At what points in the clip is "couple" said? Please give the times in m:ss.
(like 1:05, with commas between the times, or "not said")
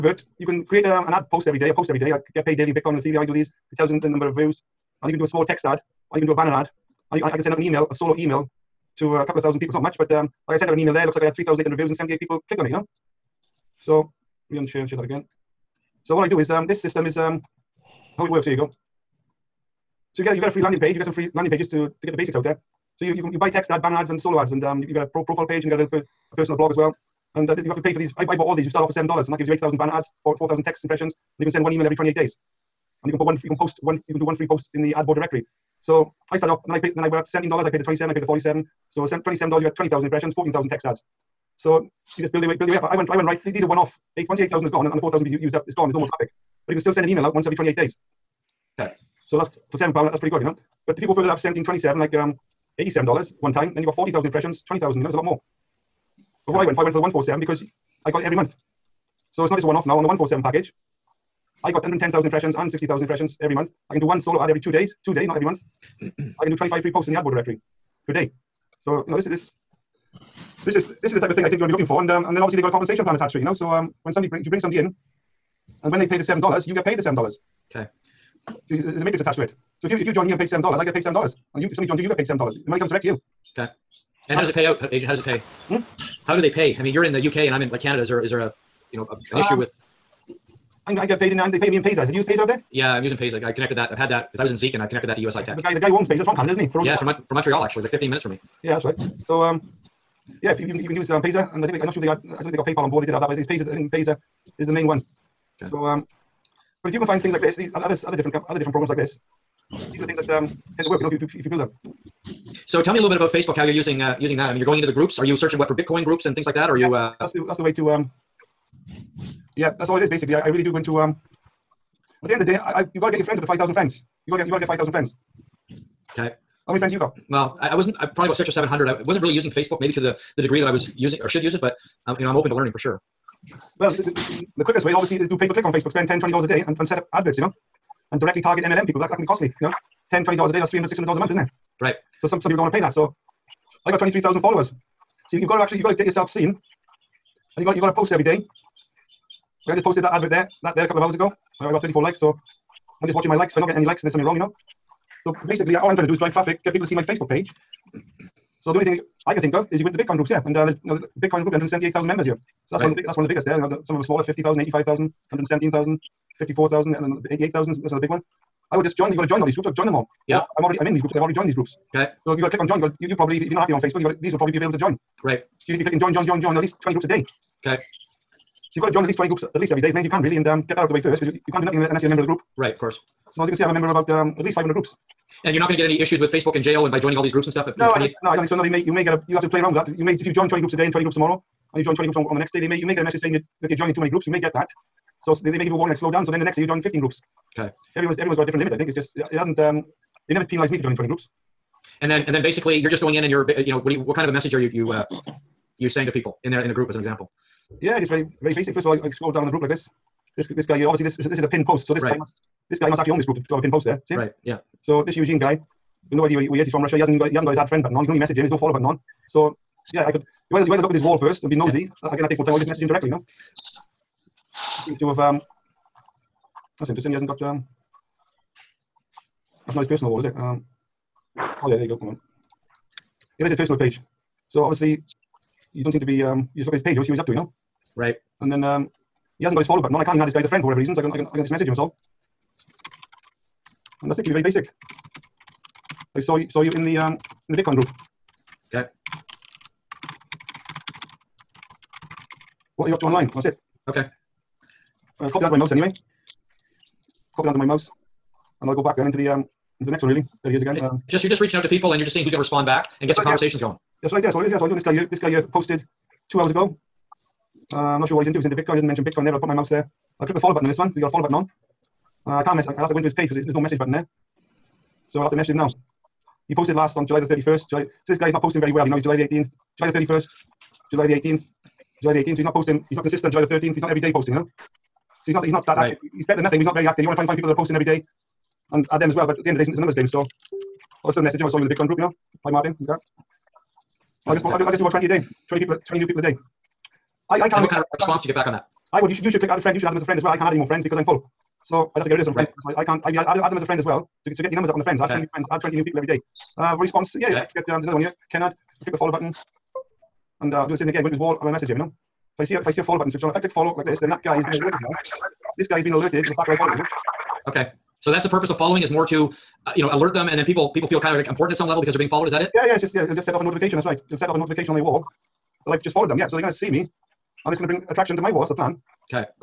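0:09, 2:30.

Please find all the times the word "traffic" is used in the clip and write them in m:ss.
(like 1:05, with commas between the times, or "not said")
0:46, 2:36.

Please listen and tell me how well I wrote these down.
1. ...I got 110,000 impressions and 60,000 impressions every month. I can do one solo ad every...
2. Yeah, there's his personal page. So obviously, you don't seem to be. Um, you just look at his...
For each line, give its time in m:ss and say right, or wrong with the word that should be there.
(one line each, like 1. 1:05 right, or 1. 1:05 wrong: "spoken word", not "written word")
1. 1:01 right
2. 3:53 right.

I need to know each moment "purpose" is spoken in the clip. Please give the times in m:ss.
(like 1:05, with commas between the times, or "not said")
5:18.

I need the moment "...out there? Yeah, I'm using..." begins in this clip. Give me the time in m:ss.
1:32.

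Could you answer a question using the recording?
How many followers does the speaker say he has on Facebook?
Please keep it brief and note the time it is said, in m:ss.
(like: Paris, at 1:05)
23,000, at 2:23.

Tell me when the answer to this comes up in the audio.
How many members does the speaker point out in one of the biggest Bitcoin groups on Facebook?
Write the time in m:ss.
2:41.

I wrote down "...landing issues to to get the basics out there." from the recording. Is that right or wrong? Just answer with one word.
wrong.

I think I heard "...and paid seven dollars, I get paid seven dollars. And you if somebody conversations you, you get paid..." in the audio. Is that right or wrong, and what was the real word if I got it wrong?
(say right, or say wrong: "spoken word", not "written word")
wrong: "joins", not "conversations".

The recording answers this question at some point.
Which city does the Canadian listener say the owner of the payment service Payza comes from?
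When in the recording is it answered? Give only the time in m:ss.
1:37.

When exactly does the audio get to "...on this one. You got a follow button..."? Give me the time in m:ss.
4:30.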